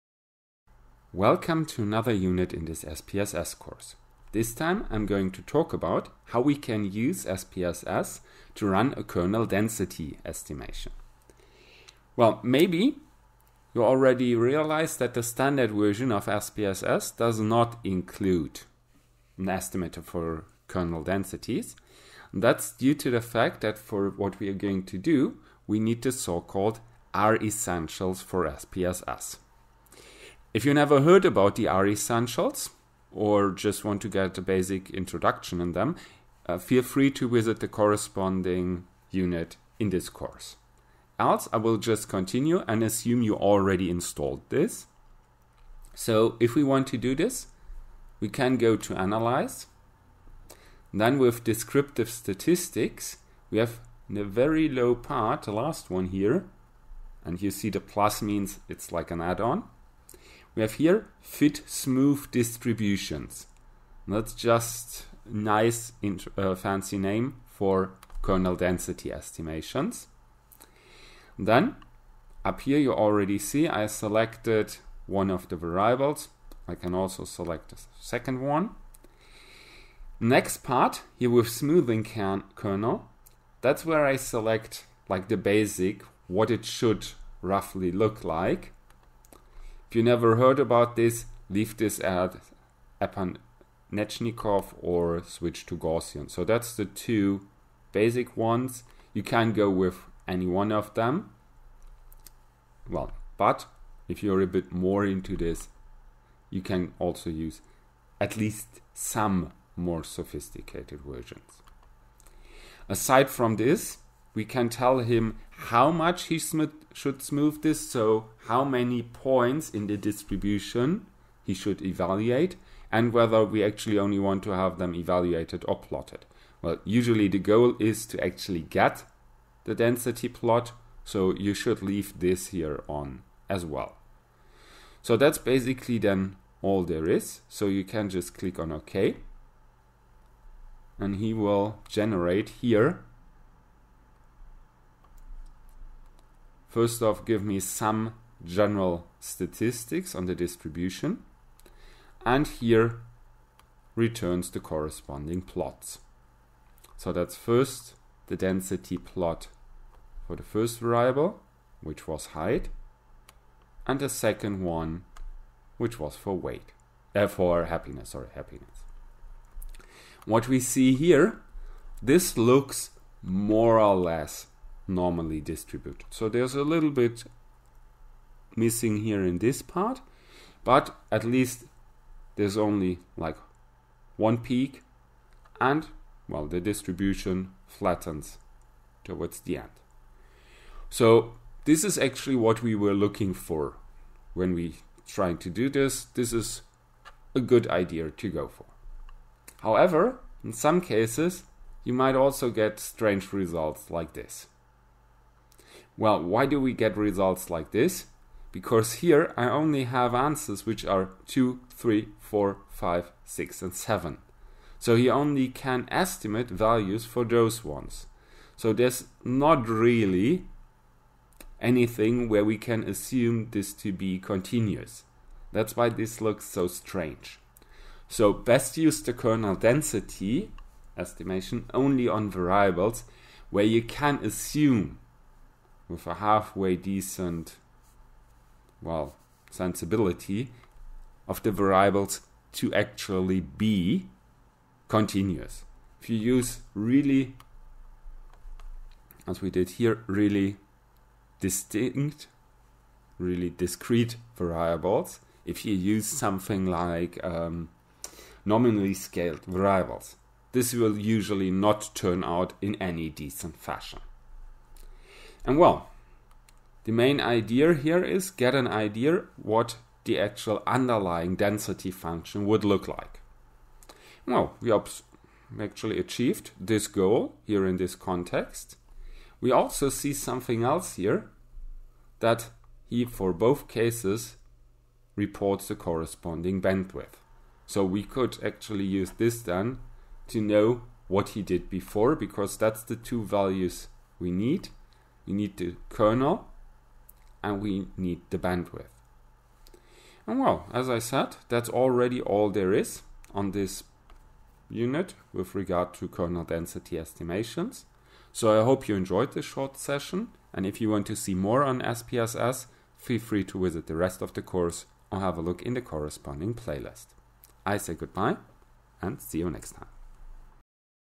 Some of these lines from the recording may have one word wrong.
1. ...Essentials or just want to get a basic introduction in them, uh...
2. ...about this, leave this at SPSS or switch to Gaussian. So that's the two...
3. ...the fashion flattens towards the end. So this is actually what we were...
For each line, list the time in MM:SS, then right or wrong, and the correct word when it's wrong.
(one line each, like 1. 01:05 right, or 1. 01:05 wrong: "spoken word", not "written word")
1. 00:31 right
2. 01:30 wrong: "Epanechnikov", not "SPSS"
3. 03:06 wrong: "distribution", not "fashion".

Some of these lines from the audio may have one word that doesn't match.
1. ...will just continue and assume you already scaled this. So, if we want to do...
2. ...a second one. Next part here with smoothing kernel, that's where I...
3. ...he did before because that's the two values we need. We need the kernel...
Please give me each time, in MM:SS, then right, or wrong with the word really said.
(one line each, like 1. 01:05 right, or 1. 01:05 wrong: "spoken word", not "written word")
1. 00:41 wrong: "installed", not "scaled"
2. 01:17 right
3. 04:51 right.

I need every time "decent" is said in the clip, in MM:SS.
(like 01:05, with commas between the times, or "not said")
03:56, 04:23.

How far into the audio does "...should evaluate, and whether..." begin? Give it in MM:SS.
02:01.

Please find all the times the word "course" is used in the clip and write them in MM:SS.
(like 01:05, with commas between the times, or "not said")
00:03, 00:40, 05:14.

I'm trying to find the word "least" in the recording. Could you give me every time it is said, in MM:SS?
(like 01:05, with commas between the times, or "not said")
01:48, 03:01.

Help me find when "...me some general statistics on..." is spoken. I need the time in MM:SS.
02:27.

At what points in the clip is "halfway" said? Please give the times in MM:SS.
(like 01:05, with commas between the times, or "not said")
03:56.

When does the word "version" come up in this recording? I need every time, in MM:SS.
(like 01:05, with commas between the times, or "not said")
00:15, 01:51.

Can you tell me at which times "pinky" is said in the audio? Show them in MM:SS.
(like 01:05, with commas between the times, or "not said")
not said.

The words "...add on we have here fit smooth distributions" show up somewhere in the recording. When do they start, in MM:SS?
00:59.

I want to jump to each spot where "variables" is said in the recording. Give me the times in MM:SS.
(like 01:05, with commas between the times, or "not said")
01:15, 02:40, 03:52, 04:01, 04:14, 04:19.